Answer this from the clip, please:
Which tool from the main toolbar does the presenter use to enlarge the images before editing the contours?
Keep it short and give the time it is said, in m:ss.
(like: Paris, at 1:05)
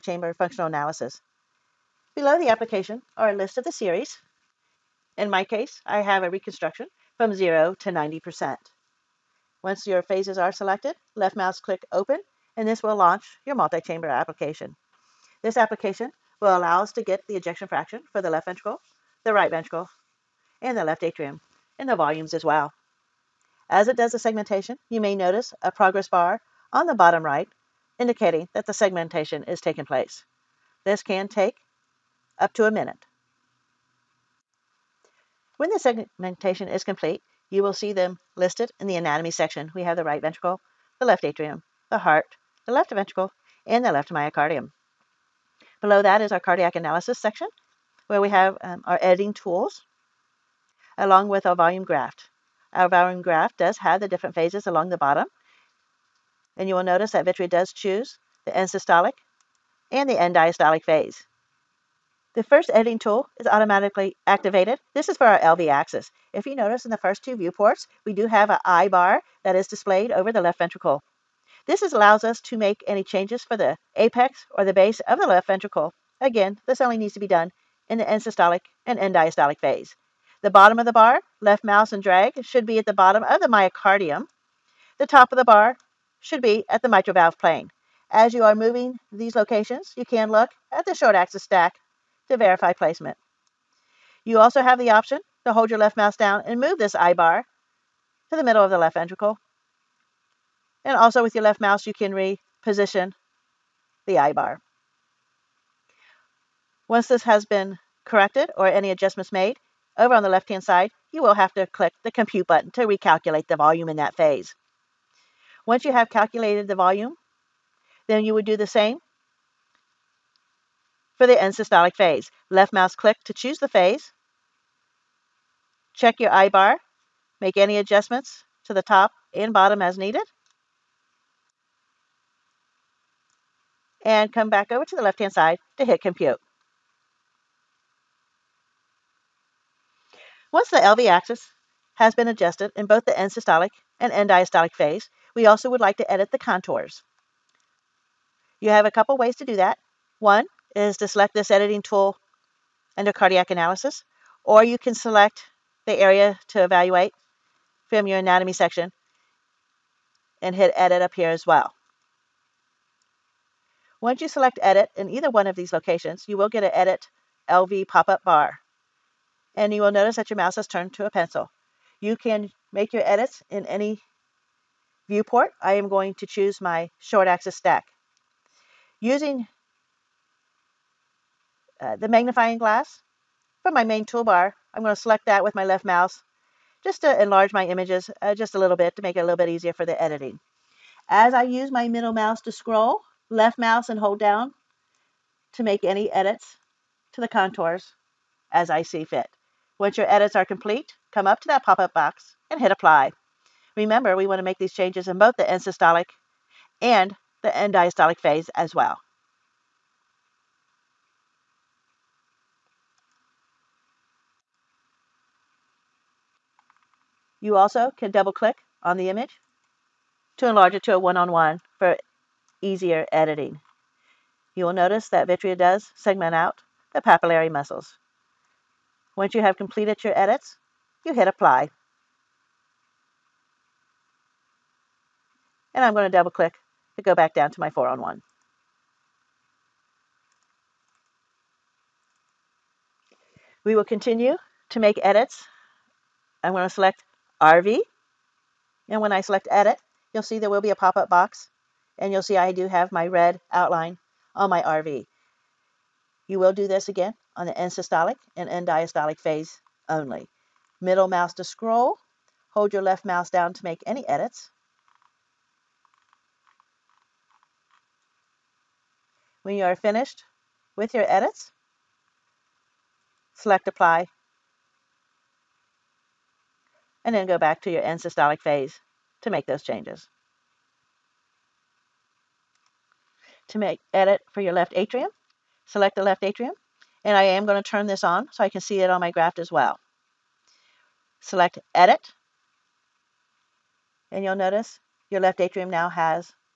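Magnifying glass, at 3:02.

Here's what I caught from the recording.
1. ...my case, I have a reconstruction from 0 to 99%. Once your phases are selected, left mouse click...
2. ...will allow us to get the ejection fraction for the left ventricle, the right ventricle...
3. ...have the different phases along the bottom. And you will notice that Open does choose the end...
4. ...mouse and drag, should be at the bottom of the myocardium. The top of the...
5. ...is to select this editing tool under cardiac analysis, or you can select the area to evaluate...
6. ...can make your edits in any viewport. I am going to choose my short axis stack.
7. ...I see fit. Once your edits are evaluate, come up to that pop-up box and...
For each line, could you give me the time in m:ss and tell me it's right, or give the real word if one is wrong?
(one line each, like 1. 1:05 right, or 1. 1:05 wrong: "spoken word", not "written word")
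1. 0:05 wrong: "90", not "99"
2. 0:16 right
3. 0:53 wrong: "Vitrea", not "Open"
4. 1:21 right
5. 2:30 right
6. 2:52 right
7. 3:18 wrong: "complete", not "evaluate".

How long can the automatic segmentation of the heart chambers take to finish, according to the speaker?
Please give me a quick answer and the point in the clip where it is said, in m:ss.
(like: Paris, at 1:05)
Up to a minute, at 0:32.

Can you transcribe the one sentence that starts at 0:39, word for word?
We have the right ventricle, the left atrium, the heart, the left ventricle, and the left myocardium.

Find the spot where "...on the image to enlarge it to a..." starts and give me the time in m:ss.
3:38.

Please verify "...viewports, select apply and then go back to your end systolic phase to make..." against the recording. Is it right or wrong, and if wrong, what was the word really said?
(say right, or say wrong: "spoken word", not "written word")
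wrong: "edits", not "viewports".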